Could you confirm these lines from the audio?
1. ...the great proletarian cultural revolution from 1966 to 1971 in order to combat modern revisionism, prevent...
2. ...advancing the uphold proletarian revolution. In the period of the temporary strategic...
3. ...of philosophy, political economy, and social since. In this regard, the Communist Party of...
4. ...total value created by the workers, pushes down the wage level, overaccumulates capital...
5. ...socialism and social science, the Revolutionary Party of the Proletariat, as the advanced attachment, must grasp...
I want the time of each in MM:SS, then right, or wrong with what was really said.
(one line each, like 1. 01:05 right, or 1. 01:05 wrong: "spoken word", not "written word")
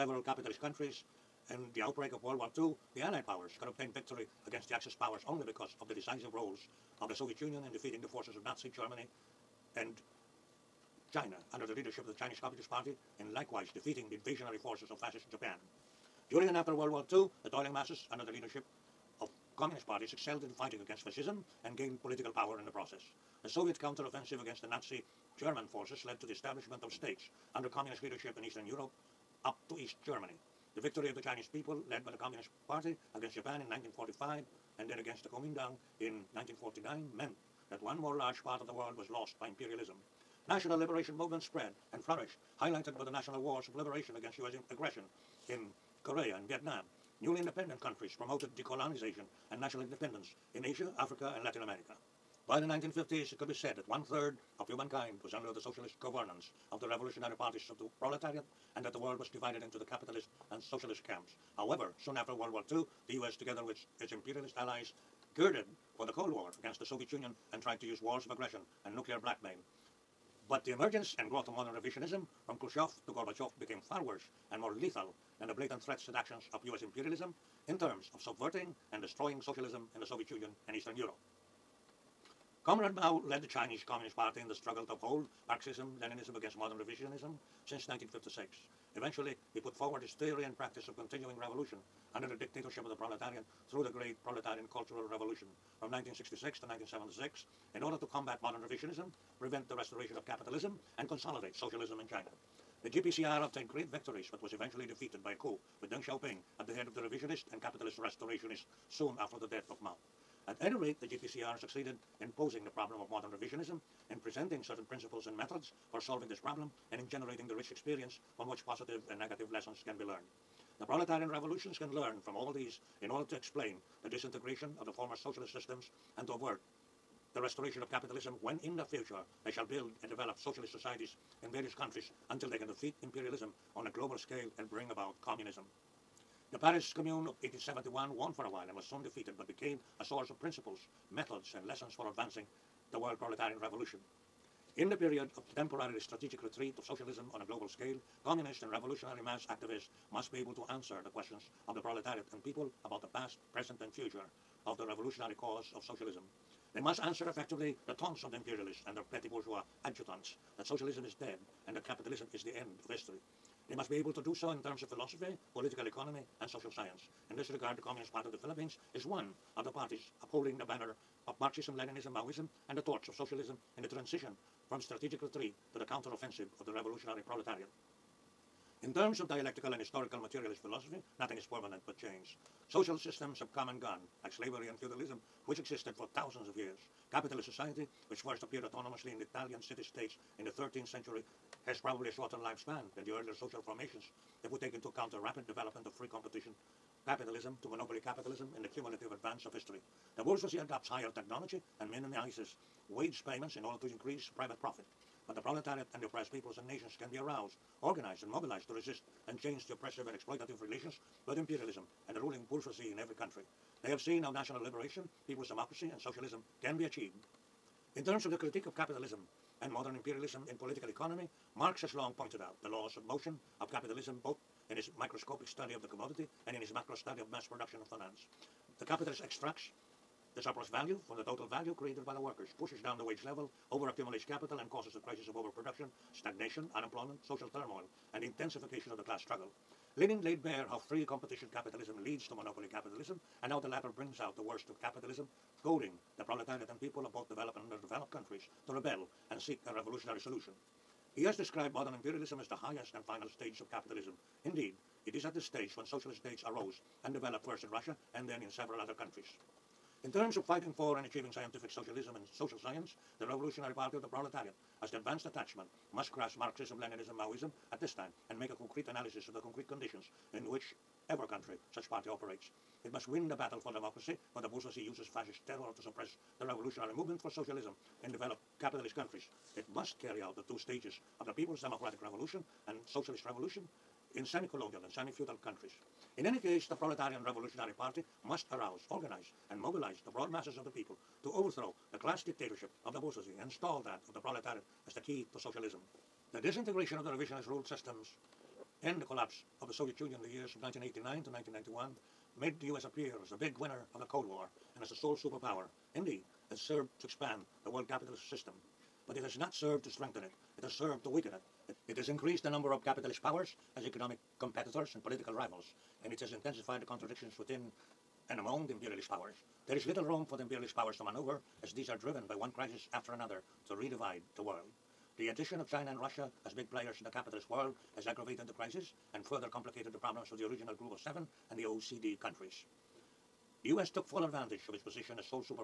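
1. 01:33 wrong: "1976", not "1971"
2. 02:22 wrong: "world", not "uphold"
3. 02:44 wrong: "science", not "since"
4. 03:51 right
5. 04:21 right.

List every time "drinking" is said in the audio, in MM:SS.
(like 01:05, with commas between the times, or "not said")
not said.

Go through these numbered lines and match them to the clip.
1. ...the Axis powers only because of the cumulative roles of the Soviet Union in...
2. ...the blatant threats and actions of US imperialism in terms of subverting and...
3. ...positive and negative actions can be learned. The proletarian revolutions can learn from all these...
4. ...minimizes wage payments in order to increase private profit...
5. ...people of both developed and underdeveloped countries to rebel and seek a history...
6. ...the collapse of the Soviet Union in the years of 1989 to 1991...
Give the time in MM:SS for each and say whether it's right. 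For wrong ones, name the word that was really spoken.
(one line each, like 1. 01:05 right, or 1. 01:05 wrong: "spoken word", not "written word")
1. 00:04 wrong: "decisive", not "cumulative"
2. 01:15 right
3. 01:58 wrong: "lessons", not "actions"
4. 03:21 right
5. 04:06 wrong: "revolutionary", not "history"
6. 04:58 right.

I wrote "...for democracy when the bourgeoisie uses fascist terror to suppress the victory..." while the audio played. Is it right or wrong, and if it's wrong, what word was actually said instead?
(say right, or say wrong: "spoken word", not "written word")
wrong: "revolutionary", not "victory".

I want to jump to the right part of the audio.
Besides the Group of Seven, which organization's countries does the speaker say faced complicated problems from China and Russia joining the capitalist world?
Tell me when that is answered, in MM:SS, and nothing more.
05:31.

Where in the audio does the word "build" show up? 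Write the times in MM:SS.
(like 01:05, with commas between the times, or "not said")
02:09.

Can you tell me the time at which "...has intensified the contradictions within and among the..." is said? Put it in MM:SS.
05:16.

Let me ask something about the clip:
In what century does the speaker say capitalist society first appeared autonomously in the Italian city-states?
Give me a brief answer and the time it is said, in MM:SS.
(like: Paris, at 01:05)
13th century, at 03:10.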